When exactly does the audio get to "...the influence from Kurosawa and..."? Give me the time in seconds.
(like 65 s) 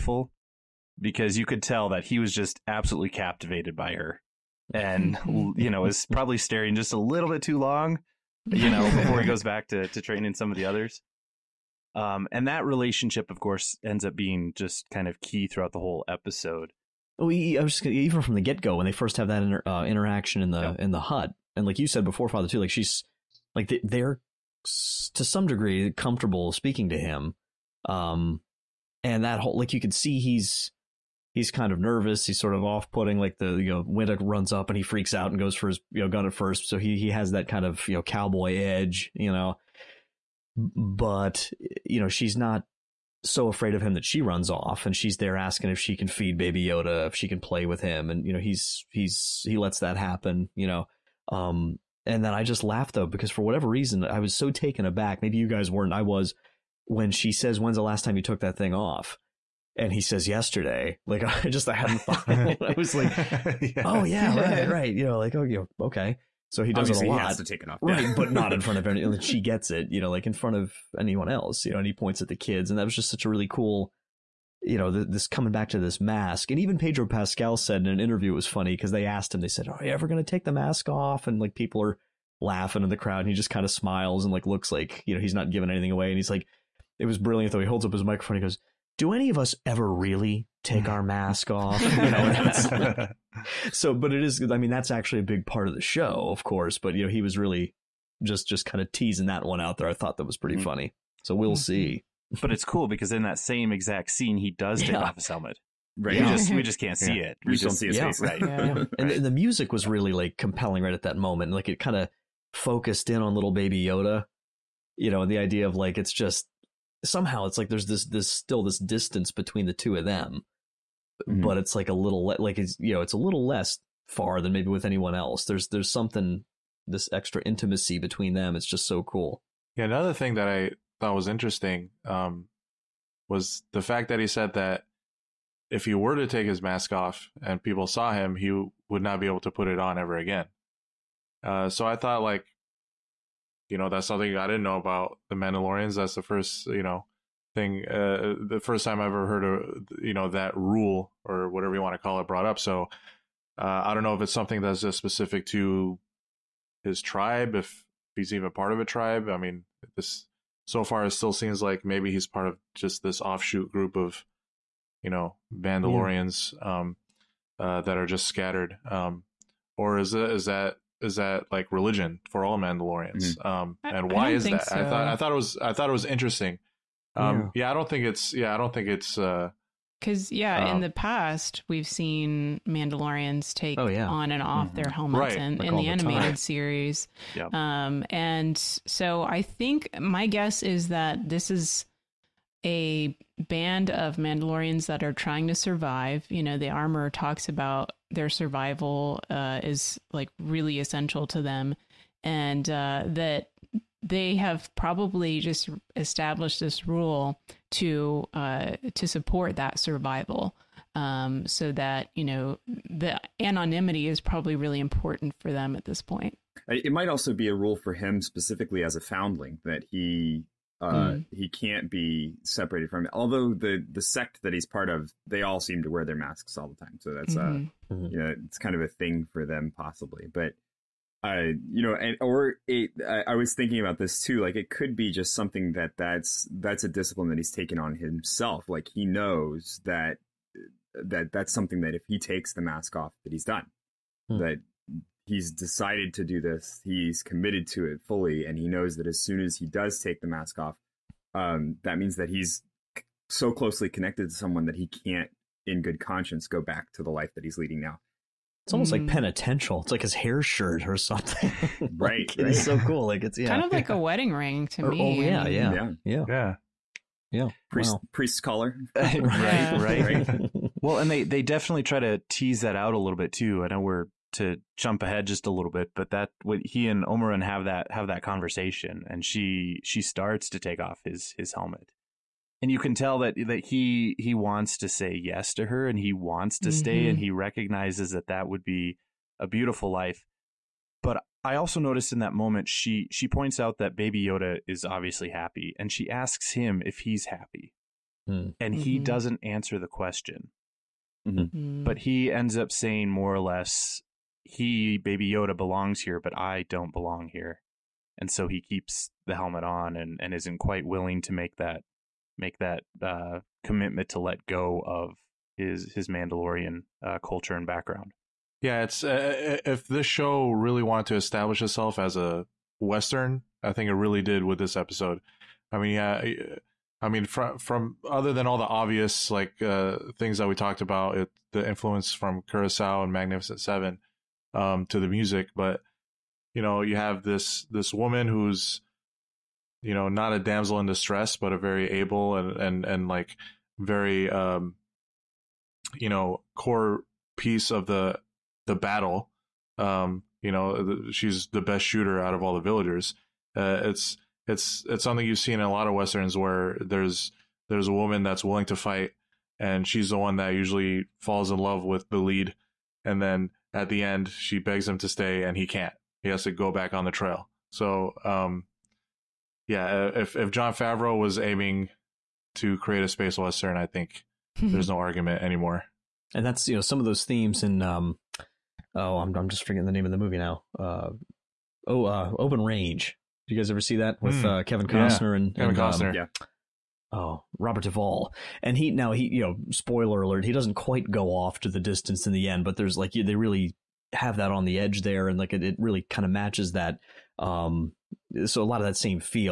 331 s.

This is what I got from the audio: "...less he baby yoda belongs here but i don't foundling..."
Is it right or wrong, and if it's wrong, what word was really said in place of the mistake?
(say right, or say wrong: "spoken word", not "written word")
wrong: "belong", not "foundling".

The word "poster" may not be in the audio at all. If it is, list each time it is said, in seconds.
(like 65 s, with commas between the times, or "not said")
not said.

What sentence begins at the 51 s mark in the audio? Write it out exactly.
Um, and then I just laughed though because for whatever reason I was so taken aback.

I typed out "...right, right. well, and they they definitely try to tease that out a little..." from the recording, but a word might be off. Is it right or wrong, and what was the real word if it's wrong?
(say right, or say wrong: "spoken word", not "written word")
right.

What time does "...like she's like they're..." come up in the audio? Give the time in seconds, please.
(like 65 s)
22 s.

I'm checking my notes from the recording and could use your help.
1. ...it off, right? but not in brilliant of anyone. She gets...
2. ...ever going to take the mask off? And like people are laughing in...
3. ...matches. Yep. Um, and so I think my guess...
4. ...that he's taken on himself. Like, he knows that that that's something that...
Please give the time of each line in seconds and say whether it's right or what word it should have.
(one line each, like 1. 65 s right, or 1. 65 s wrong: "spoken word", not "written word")
1. 67 s wrong: "front", not "brilliant"
2. 79 s right
3. 186 s wrong: "series", not "matches"
4. 237 s right.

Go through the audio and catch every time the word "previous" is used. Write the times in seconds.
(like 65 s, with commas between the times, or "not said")
not said.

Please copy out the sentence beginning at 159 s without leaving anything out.
I mean, this so far it still seems like maybe he's part of just this offshoot group of you know Mandalorians yeah.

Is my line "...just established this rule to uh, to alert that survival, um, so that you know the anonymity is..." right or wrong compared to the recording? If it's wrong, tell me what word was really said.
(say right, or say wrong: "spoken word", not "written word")
wrong: "support", not "alert".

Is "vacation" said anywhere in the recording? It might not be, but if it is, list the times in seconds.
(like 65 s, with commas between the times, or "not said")
not said.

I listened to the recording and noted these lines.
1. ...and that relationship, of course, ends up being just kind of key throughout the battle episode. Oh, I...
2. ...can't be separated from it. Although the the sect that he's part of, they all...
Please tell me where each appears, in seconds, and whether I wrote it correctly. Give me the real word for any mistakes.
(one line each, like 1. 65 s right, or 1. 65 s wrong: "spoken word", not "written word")
1. 12 s wrong: "whole", not "battle"
2. 221 s right.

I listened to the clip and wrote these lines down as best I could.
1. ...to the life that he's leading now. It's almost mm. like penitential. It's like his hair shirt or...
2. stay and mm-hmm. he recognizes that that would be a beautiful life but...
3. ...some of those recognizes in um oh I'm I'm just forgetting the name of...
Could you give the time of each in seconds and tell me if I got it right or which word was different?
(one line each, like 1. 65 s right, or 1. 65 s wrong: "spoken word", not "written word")
1. 256 s right
2. 286 s right
3. 376 s wrong: "themes", not "recognizes".